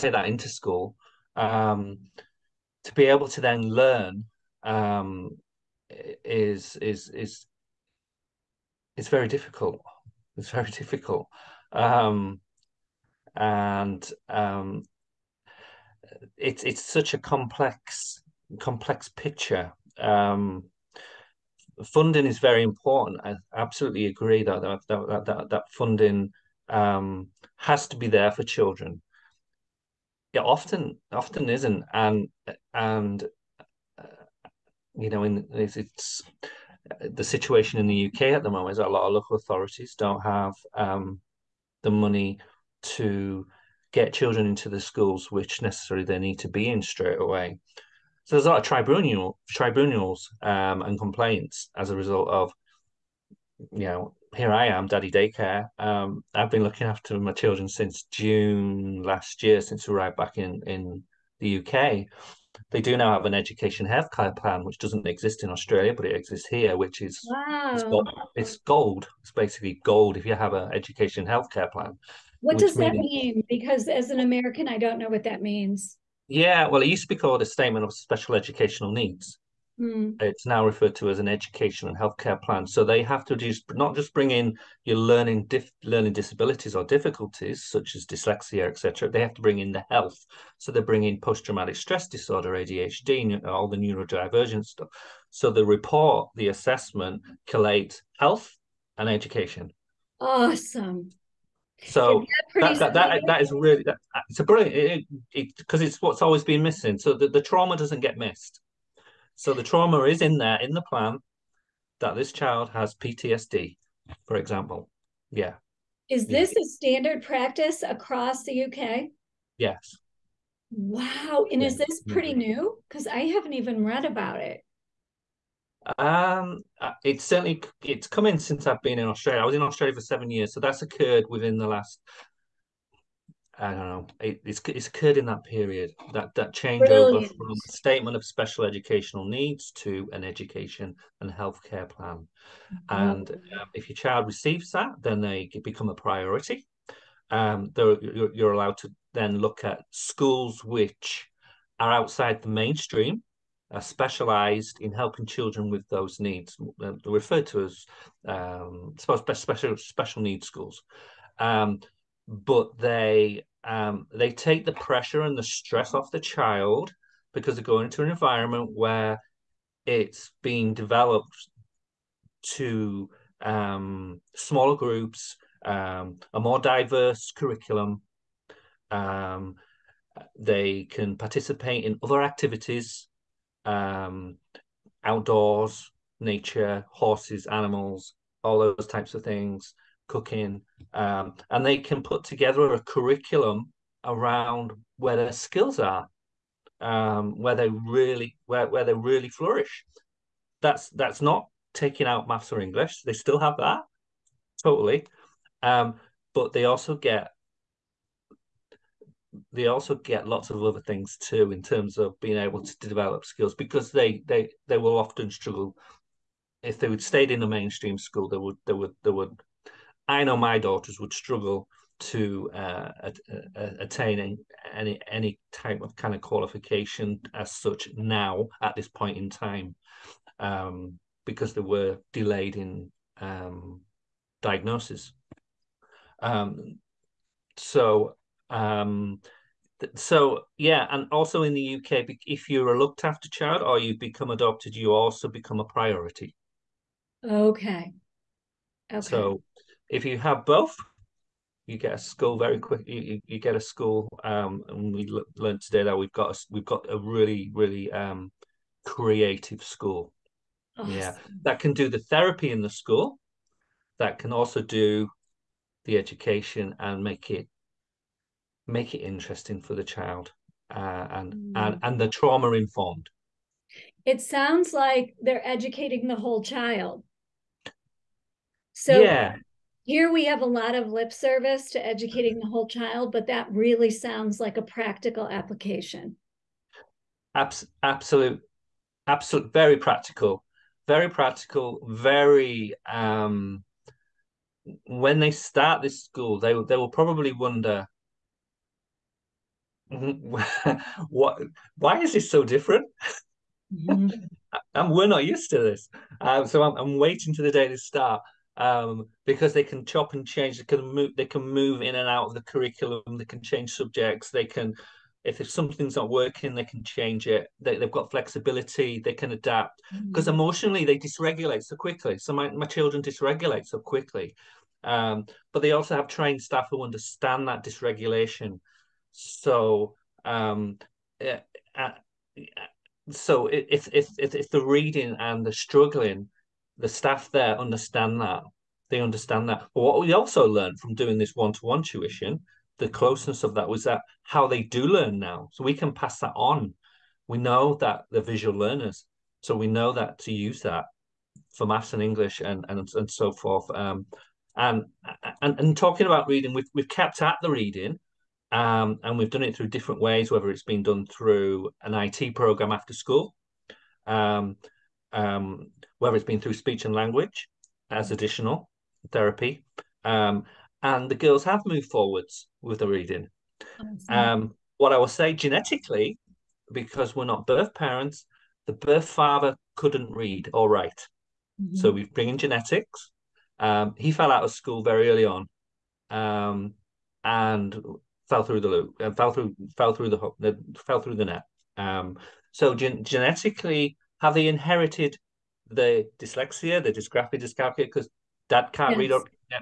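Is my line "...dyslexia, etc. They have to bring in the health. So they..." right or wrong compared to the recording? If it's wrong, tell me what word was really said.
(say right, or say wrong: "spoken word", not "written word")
right.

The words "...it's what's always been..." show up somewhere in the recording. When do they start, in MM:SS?
01:45.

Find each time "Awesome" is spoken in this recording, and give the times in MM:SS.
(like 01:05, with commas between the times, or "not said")
01:40, 04:20.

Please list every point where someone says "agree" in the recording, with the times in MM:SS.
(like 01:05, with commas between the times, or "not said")
00:24.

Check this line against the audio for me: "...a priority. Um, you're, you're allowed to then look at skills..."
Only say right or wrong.
wrong.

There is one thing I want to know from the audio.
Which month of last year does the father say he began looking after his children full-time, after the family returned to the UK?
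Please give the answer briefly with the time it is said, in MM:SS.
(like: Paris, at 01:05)
June, at 00:58.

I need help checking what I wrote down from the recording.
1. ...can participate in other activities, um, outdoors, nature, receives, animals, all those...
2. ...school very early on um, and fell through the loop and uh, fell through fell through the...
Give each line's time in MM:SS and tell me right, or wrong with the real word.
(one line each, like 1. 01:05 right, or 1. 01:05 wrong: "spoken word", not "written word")
1. 03:00 wrong: "horses", not "receives"
2. 06:24 right.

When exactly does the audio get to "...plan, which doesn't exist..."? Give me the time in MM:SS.
01:04.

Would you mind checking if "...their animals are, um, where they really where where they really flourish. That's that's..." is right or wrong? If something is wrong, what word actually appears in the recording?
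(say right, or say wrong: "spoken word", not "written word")
wrong: "skills", not "animals".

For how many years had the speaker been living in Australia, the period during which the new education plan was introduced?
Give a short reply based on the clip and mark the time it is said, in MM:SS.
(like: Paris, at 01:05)
7, at 02:10.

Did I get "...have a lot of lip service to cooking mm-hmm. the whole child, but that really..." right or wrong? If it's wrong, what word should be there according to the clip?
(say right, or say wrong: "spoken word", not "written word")
wrong: "educating", not "cooking".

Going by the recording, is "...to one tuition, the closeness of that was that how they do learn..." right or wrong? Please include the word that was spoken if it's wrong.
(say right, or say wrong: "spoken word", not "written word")
right.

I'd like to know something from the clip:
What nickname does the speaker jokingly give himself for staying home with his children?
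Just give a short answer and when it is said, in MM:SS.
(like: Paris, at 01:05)
Daddy daycare, at 00:54.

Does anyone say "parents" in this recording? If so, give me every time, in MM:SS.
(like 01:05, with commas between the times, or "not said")
06:17.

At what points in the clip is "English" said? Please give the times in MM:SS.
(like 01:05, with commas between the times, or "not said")
03:22, 05:52.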